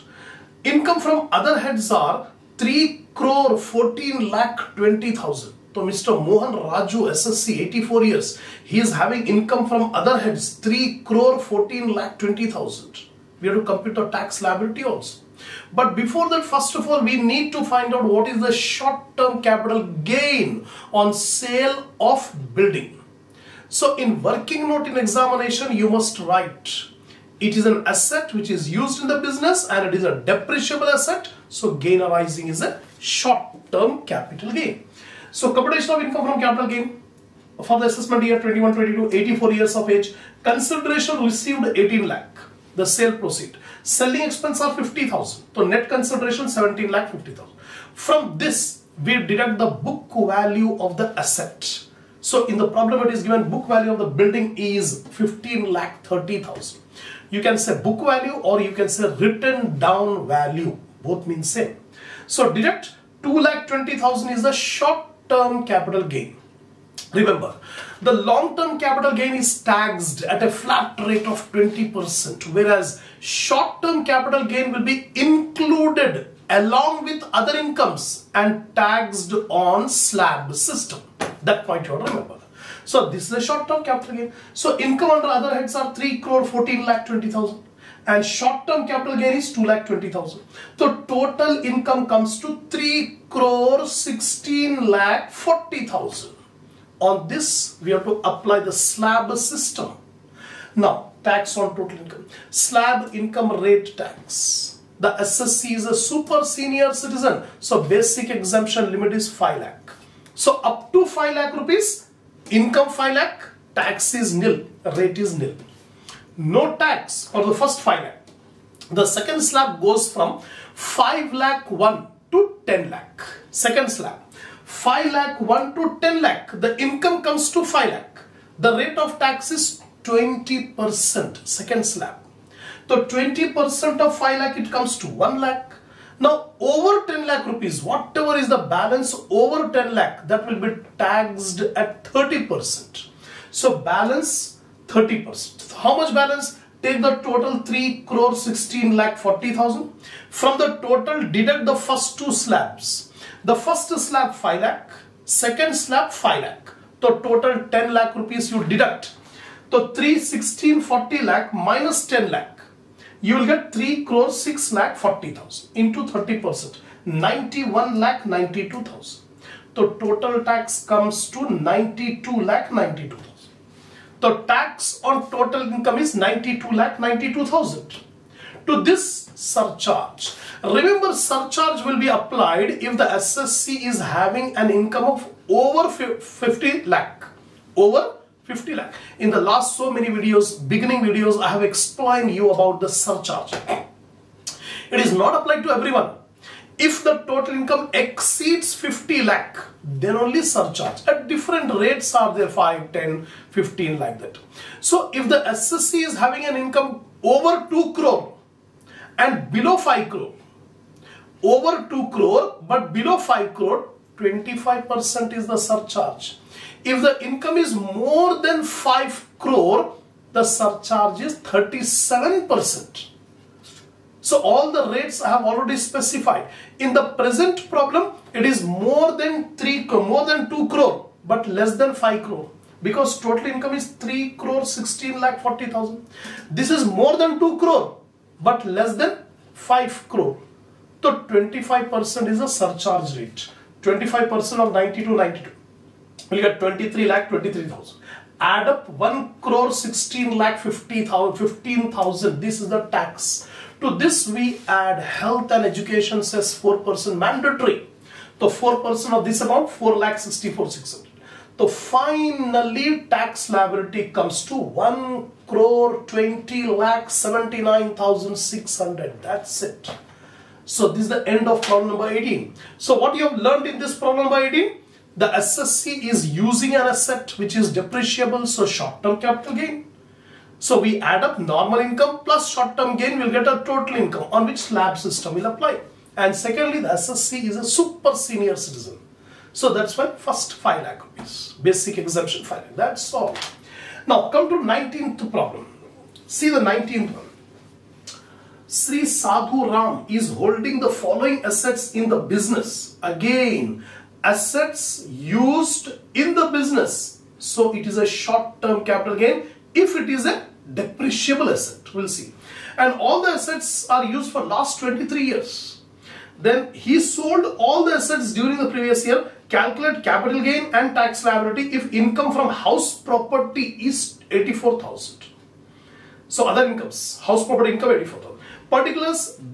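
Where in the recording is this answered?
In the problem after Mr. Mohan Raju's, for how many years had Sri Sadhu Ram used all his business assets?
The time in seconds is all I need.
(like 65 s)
314 s.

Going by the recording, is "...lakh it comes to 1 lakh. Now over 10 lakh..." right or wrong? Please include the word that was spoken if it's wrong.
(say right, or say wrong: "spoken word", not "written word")
right.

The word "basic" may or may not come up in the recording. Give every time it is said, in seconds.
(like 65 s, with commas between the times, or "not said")
107 s, 291 s.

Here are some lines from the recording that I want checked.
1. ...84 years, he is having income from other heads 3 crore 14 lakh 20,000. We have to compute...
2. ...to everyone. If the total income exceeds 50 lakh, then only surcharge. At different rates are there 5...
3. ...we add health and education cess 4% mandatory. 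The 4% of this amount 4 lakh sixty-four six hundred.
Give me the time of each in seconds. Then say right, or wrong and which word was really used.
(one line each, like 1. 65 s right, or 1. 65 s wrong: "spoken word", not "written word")
1. 7 s right
2. 195 s right
3. 254 s right.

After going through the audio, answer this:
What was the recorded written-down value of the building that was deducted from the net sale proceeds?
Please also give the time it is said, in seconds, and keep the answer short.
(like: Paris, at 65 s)
15 lakh 30,000, at 55 s.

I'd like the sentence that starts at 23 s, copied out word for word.
So in working note in examination, you must write.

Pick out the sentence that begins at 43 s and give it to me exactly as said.
Selling expense are 50,000, so net consideration 17 lakh 50,000.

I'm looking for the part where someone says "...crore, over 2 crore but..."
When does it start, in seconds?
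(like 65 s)
210 s.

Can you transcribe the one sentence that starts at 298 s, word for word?
Sri Sadhu Ram is holding the following assets in the business.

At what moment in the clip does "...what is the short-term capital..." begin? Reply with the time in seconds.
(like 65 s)
18 s.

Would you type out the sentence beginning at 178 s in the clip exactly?
To this surcharge, remember surcharge will be applied if the assessee is having an income of over 50 lakh, over 50 lakh.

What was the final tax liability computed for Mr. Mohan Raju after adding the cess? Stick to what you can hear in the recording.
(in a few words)
1 crore 20 lakh 79,600.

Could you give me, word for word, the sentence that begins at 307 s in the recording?
So it is a short-term capital gain if it is a depreciable asset.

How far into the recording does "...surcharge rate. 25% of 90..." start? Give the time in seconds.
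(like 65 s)
242 s.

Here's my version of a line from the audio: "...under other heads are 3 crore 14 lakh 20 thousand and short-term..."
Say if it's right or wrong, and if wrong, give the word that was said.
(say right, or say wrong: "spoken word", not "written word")
right.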